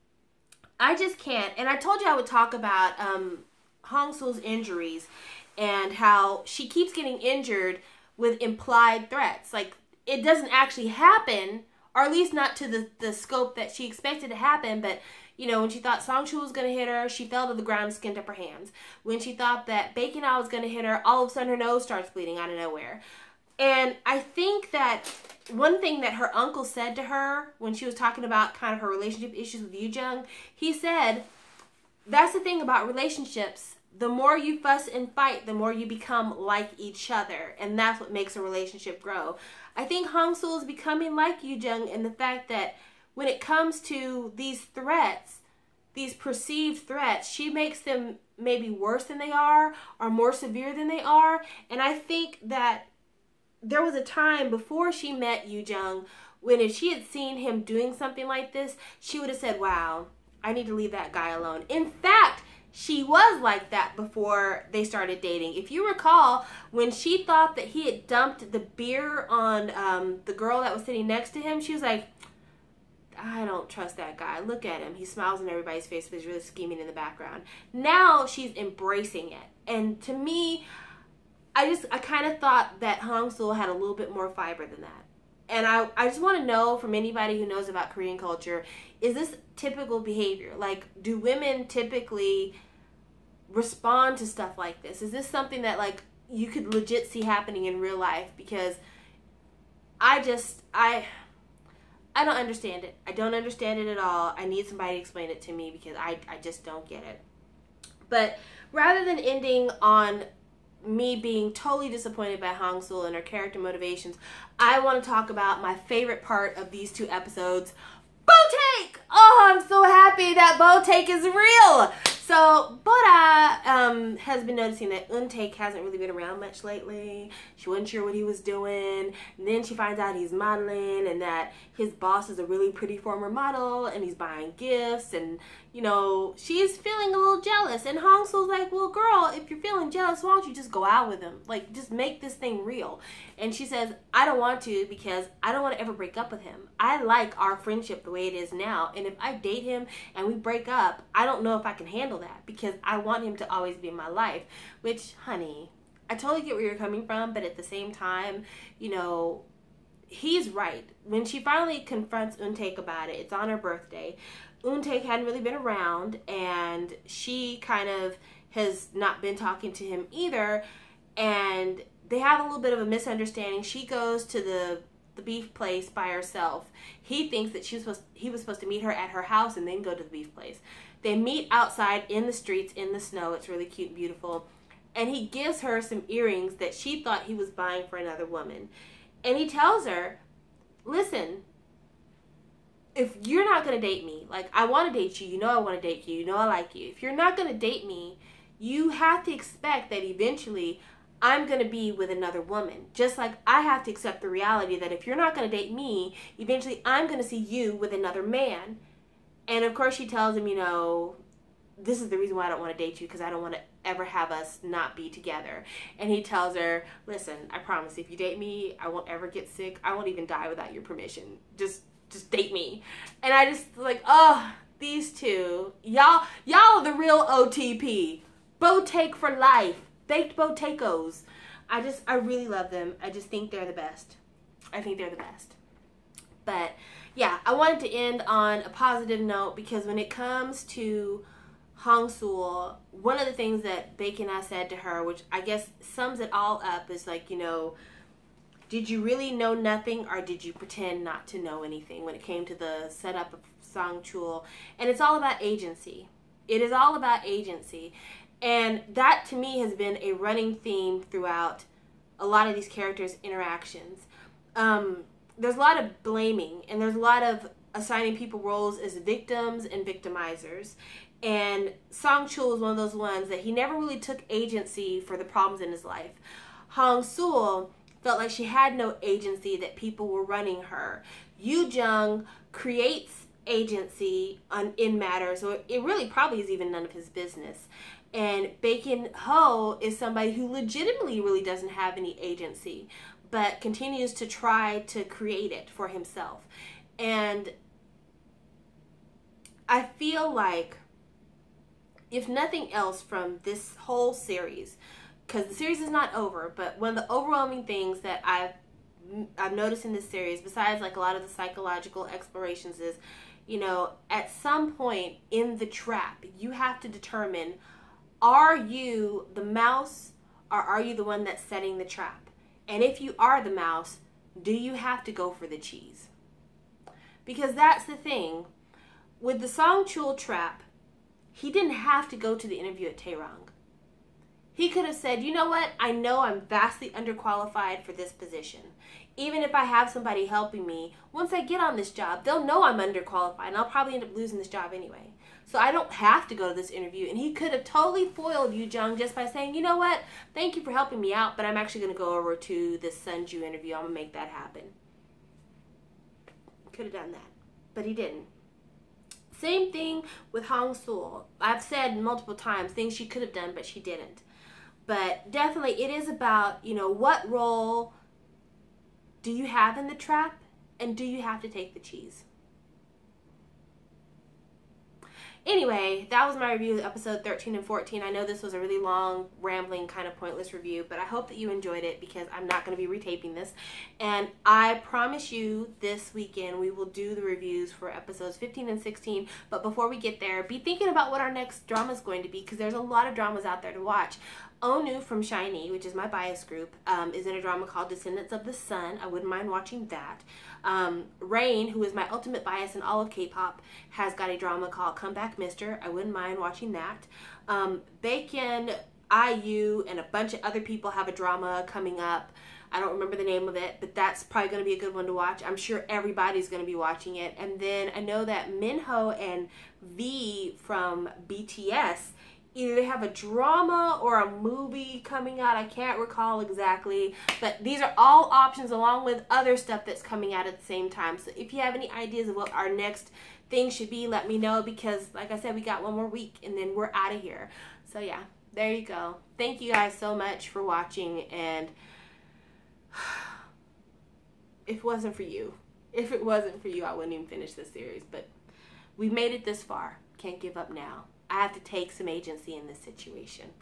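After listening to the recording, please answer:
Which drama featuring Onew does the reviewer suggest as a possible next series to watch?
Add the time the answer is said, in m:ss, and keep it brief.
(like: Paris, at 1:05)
Descendants of the Sun, at 6:37.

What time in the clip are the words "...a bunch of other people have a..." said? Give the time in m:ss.
6:49.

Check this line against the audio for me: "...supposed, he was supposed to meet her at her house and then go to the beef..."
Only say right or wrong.
right.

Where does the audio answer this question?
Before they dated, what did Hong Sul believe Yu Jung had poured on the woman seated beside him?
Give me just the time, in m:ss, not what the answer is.
1:08.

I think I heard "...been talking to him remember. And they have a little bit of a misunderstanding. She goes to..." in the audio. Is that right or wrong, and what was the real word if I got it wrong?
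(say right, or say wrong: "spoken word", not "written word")
wrong: "either", not "remember".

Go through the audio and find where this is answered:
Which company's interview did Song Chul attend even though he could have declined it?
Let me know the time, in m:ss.
5:32.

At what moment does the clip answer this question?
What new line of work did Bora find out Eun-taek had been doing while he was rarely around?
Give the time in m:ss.
2:10.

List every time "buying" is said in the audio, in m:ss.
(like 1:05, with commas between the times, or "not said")
2:14, 3:07.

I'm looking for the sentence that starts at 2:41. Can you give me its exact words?
When she finally confronts Eun-taek about it, it's on her birthday.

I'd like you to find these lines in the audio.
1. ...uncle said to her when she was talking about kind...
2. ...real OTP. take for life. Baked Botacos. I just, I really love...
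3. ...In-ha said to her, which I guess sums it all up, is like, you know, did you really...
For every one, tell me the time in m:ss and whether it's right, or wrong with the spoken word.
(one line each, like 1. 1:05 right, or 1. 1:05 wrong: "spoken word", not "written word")
1. 0:26 right
2. 3:46 right
3. 4:04 right.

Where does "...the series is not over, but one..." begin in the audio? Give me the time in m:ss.
5:05.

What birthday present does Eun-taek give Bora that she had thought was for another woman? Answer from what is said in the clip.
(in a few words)
earrings.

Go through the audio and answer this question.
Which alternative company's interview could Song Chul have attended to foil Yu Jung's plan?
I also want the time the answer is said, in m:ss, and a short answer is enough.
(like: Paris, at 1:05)
Sunju, at 5:52.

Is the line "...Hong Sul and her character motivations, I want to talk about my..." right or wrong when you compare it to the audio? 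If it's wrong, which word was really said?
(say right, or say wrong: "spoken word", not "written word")
right.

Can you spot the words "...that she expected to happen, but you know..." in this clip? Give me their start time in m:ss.
0:13.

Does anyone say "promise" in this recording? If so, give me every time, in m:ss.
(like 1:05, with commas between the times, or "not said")
3:37, 6:24.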